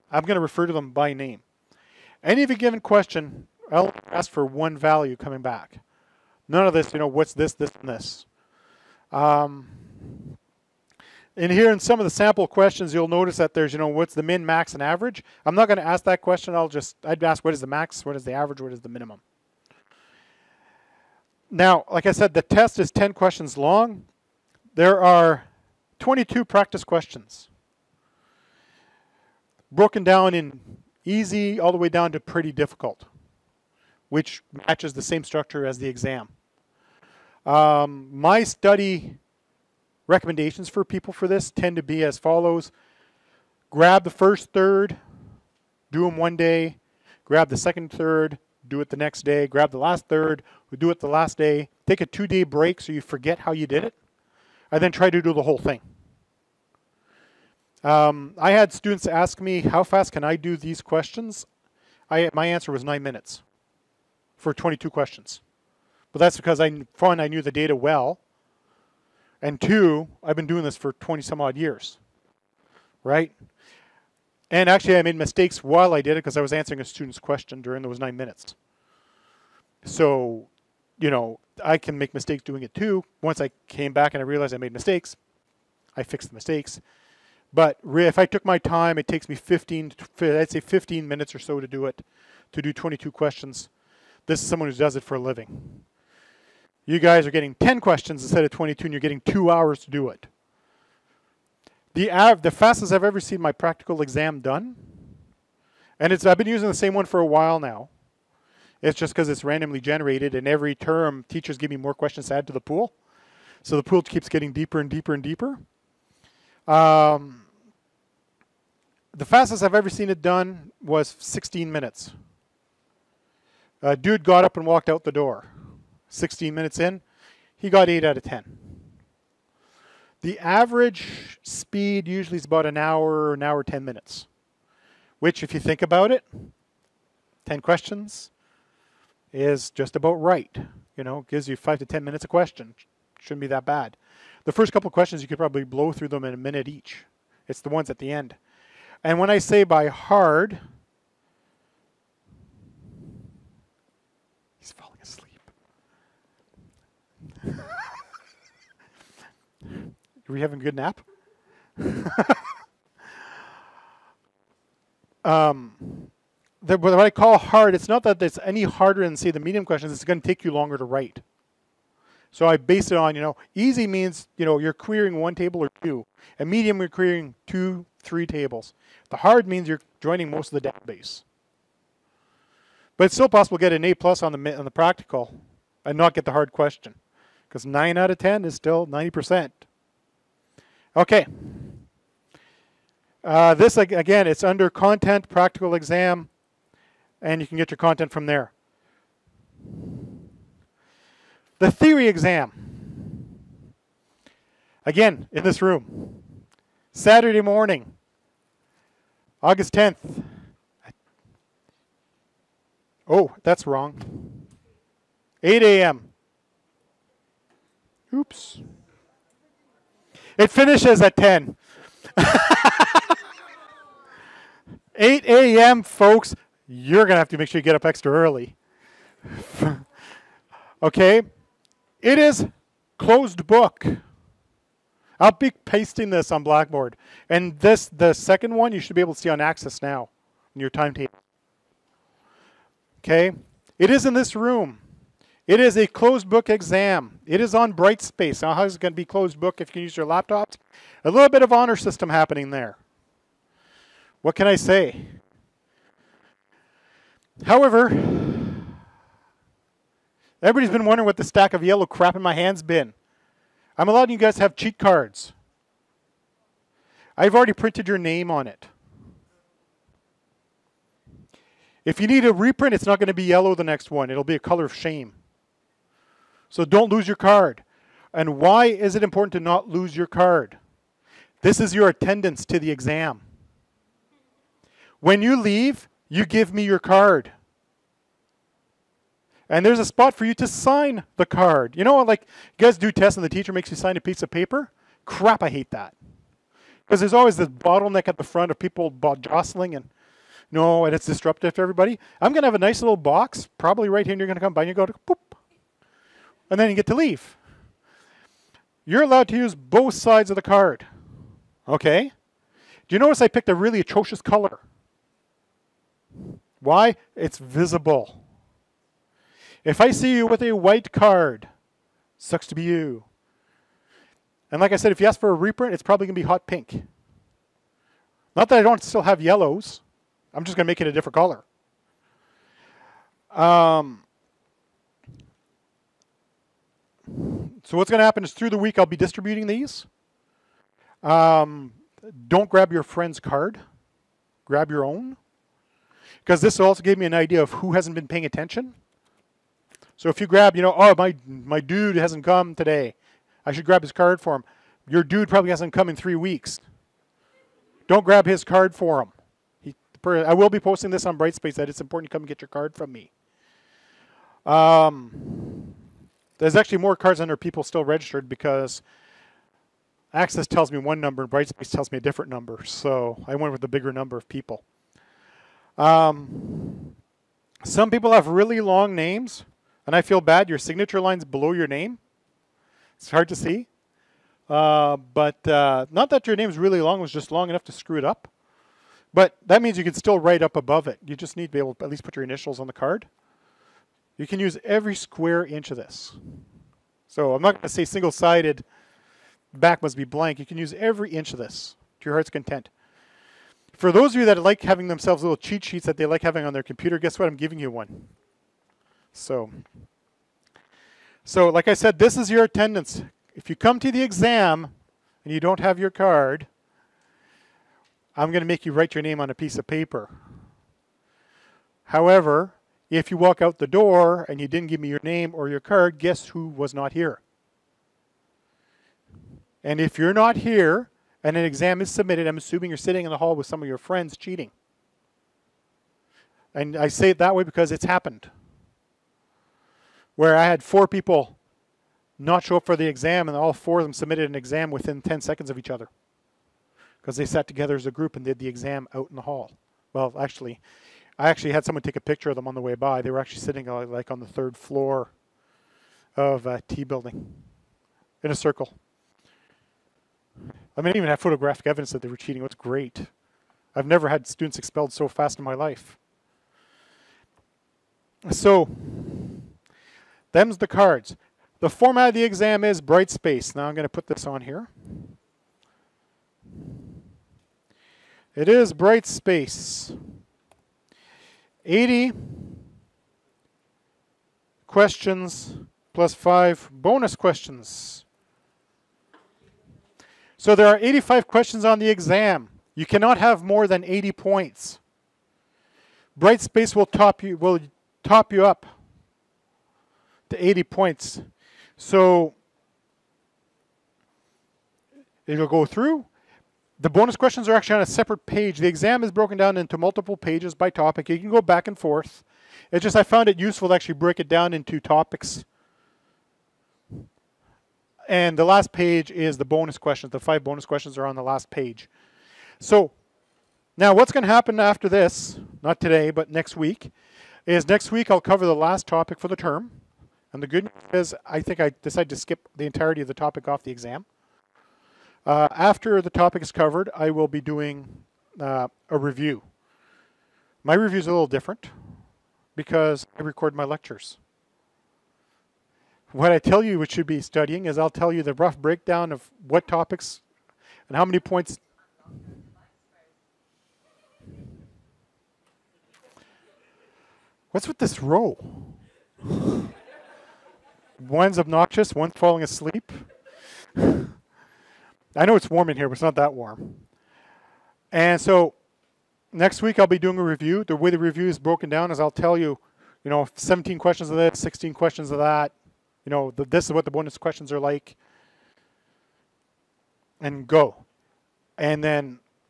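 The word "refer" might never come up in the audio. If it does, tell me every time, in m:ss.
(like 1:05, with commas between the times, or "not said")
0:00.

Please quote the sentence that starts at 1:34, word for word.
This is someone who does it for a living.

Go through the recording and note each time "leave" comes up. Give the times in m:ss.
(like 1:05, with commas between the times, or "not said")
4:45, 5:06.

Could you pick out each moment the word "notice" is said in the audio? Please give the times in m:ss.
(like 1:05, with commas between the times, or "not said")
0:13, 5:12.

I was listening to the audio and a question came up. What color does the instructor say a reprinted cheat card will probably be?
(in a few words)
Hot pink.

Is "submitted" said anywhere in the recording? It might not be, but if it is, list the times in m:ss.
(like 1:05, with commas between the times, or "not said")
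7:11, 7:23.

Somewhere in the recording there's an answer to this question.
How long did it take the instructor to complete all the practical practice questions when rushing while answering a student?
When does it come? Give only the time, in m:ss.
1:02.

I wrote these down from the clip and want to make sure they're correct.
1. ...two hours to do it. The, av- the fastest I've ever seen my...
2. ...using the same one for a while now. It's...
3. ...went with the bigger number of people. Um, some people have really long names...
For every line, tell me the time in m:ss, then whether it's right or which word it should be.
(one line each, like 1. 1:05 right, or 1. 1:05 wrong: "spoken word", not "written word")
1. 1:39 right
2. 1:46 right
3. 6:13 right.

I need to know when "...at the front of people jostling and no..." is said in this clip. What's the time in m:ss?
4:58.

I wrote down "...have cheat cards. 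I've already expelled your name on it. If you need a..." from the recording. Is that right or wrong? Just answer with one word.
wrong.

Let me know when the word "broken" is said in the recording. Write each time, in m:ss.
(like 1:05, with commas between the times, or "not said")
0:29, 8:29, 9:31.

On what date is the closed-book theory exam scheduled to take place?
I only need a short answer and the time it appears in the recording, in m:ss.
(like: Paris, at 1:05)
August 10th, at 3:29.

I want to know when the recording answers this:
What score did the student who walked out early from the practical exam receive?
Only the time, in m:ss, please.
2:07.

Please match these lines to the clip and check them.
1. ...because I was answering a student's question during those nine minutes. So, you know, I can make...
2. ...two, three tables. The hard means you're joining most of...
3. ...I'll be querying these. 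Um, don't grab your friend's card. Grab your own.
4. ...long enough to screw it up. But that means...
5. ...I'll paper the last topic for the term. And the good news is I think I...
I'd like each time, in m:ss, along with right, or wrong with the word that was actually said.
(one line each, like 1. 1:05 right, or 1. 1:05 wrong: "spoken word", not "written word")
1. 1:16 right
2. 2:57 right
3. 5:38 wrong: "distributing", not "querying"
4. 6:27 right
5. 8:48 wrong: "cover", not "paper".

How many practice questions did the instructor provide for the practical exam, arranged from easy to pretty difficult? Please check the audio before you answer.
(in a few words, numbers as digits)
22.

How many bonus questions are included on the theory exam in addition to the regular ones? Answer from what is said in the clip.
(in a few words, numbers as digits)
5.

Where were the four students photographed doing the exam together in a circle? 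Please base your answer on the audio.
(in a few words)
T building.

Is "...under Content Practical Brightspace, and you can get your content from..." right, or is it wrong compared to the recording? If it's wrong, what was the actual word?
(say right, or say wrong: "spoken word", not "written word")
wrong: "Exam", not "Brightspace".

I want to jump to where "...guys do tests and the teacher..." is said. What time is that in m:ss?
4:52.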